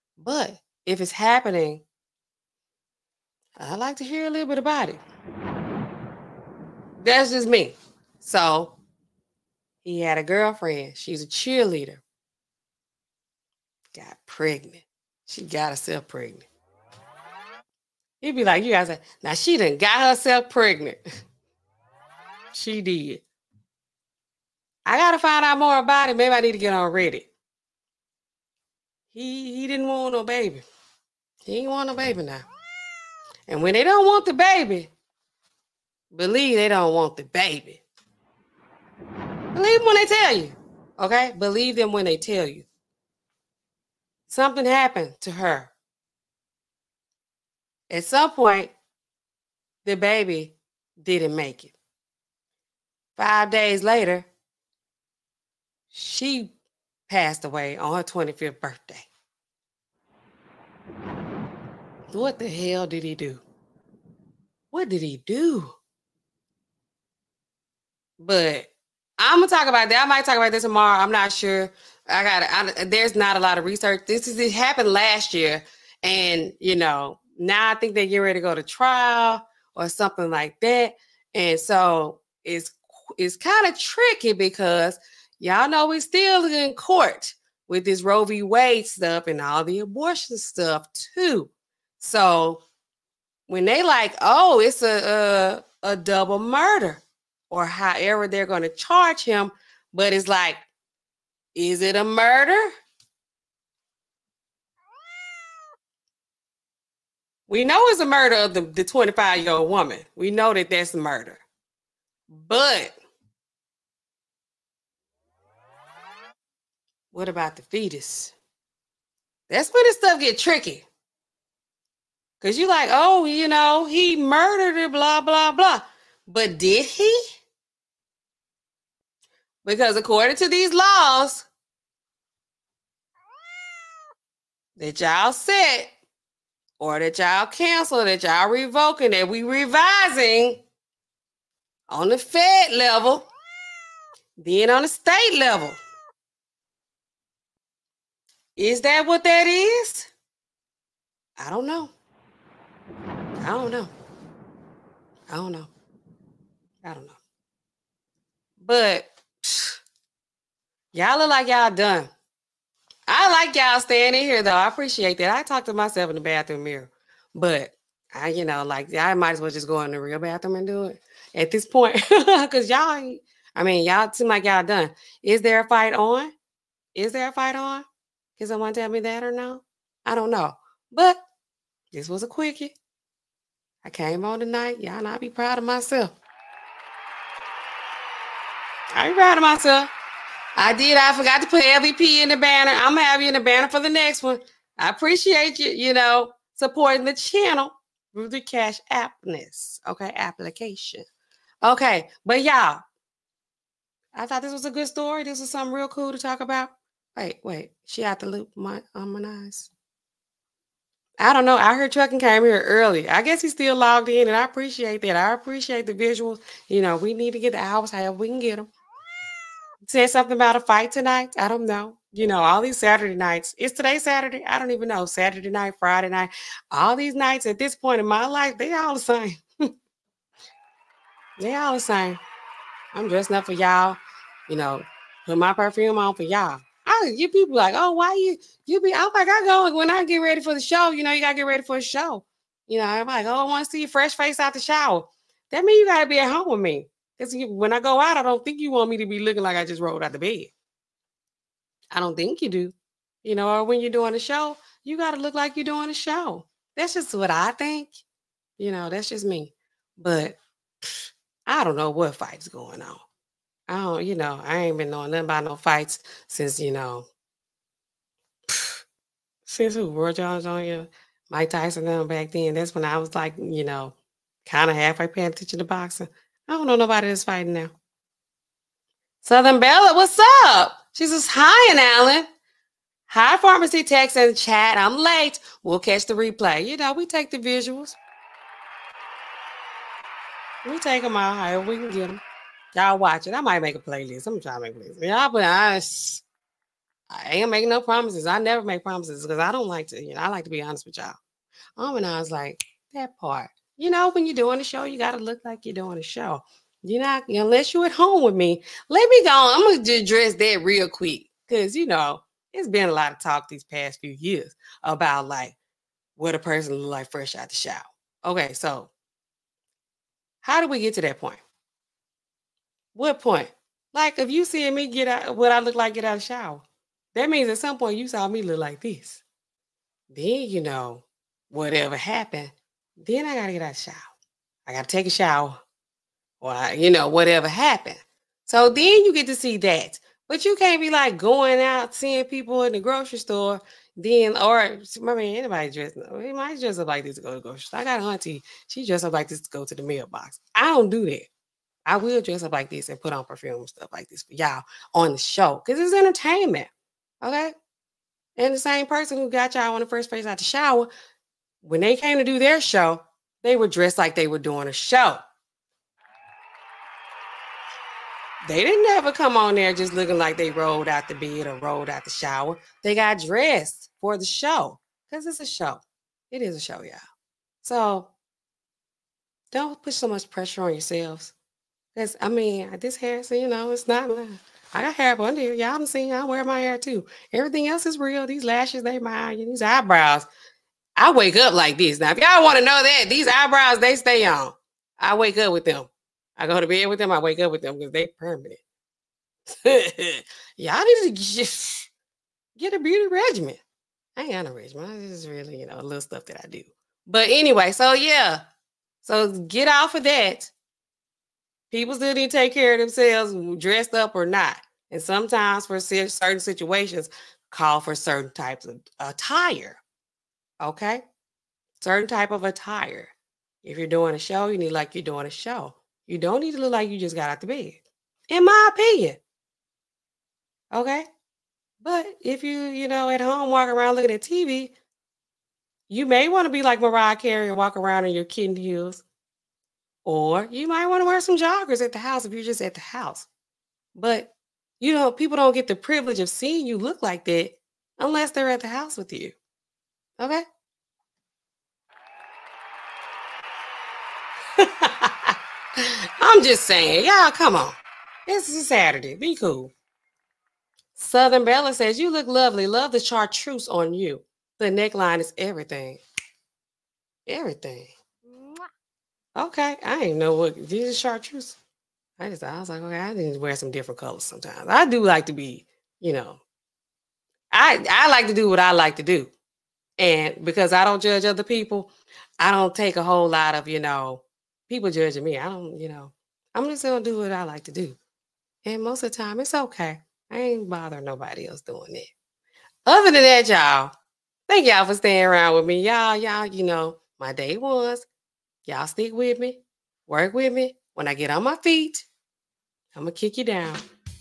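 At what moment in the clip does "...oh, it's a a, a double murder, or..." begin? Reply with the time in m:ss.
1:34.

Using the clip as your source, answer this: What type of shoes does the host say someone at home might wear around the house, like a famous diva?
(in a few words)
Kitten heels.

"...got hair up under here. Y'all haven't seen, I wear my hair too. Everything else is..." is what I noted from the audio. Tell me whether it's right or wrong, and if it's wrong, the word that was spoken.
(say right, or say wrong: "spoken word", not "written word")
right.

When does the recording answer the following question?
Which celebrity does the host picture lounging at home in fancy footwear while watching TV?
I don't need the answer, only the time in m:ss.
7:16.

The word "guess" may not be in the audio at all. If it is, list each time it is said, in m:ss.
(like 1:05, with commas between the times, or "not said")
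3:33.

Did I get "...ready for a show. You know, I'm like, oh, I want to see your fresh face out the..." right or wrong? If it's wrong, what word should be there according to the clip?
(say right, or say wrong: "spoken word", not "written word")
right.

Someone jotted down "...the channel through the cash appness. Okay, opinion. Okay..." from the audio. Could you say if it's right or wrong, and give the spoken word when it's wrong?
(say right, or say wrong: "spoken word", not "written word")
wrong: "application", not "opinion".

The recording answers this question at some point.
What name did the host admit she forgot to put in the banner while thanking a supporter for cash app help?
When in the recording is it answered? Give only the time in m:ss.
3:11.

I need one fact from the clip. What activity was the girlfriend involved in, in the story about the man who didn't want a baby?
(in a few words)
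Cheerleader.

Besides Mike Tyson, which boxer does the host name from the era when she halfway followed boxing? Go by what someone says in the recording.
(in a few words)
Roy Jones.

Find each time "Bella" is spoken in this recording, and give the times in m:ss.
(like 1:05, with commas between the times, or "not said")
4:39, 7:41.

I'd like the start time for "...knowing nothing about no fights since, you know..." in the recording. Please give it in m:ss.
4:24.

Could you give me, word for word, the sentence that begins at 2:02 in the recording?
Cause you like, oh, you know, he murdered her, blah, blah, blah.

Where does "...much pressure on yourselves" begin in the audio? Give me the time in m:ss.
6:20.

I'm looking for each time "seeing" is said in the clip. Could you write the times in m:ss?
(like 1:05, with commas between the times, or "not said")
5:24, 5:41, 7:26.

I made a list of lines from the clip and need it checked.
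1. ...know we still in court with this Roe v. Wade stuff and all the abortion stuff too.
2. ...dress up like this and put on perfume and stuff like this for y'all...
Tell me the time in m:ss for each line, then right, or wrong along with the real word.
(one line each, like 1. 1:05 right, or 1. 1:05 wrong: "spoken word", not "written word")
1. 1:25 right
2. 5:52 right.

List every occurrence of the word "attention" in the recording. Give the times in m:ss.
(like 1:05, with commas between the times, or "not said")
4:35.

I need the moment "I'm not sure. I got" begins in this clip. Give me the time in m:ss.
1:11.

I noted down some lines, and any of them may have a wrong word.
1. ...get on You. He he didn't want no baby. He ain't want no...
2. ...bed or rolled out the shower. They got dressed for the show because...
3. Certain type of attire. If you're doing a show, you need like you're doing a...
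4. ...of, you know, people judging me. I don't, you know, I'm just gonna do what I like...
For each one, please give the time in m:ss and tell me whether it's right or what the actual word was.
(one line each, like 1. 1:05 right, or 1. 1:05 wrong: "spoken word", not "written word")
1. 0:26 wrong: "Reddit", not "You"
2. 6:11 right
3. 7:01 right
4. 8:03 right.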